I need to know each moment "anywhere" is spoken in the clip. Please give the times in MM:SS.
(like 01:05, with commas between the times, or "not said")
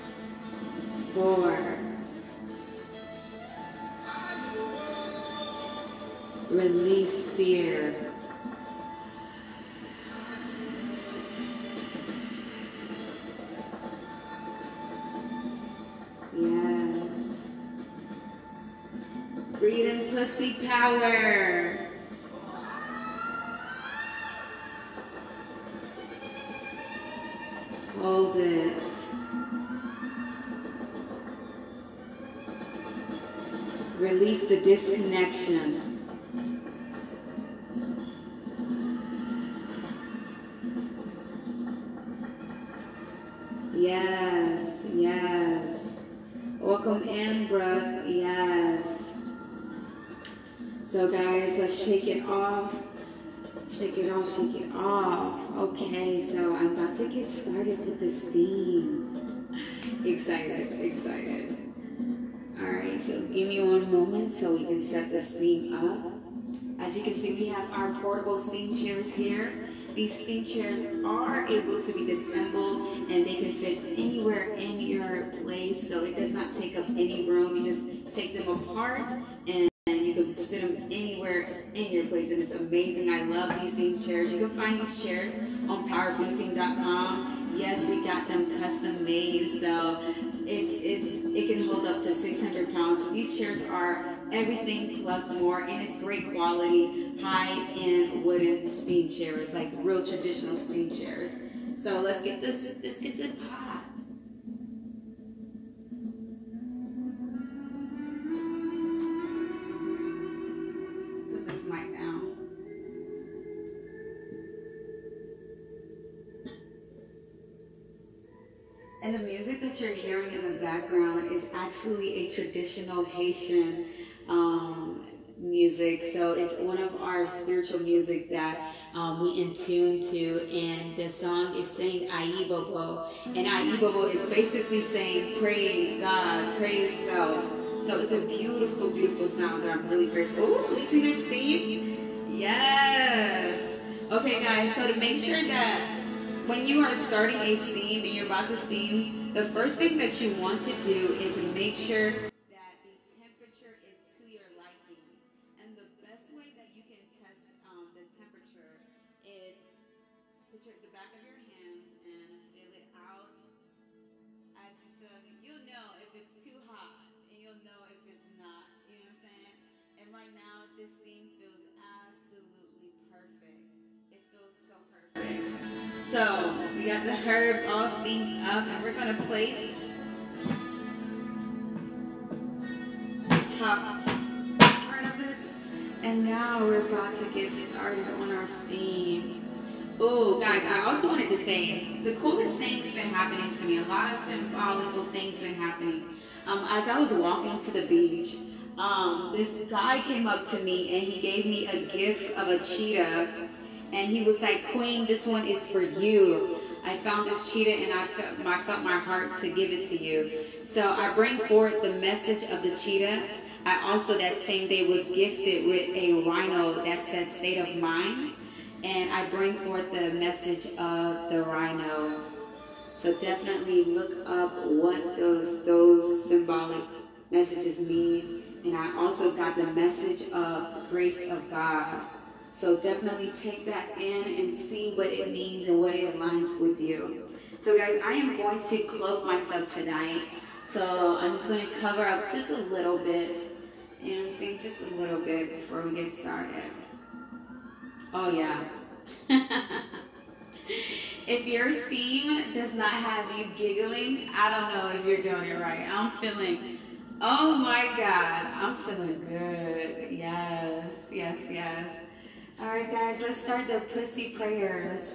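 01:13, 01:20.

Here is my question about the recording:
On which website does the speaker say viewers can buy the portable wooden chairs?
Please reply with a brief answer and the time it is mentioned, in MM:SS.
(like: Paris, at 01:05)
powerfeasting.com, at 01:25.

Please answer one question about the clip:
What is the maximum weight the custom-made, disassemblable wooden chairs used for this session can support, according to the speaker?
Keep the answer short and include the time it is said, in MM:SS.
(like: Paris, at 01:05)
600 pounds, at 01:32.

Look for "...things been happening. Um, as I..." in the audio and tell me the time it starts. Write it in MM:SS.
03:15.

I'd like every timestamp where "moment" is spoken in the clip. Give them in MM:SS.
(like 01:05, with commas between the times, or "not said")
01:03.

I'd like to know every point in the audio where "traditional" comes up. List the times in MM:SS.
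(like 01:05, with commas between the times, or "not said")
01:40, 02:02.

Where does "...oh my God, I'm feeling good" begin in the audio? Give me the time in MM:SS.
04:17.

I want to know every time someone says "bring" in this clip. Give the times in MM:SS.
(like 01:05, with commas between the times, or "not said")
03:31, 03:39.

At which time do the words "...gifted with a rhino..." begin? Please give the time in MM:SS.
03:35.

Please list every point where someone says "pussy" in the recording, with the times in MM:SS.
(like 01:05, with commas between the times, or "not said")
00:20, 04:23.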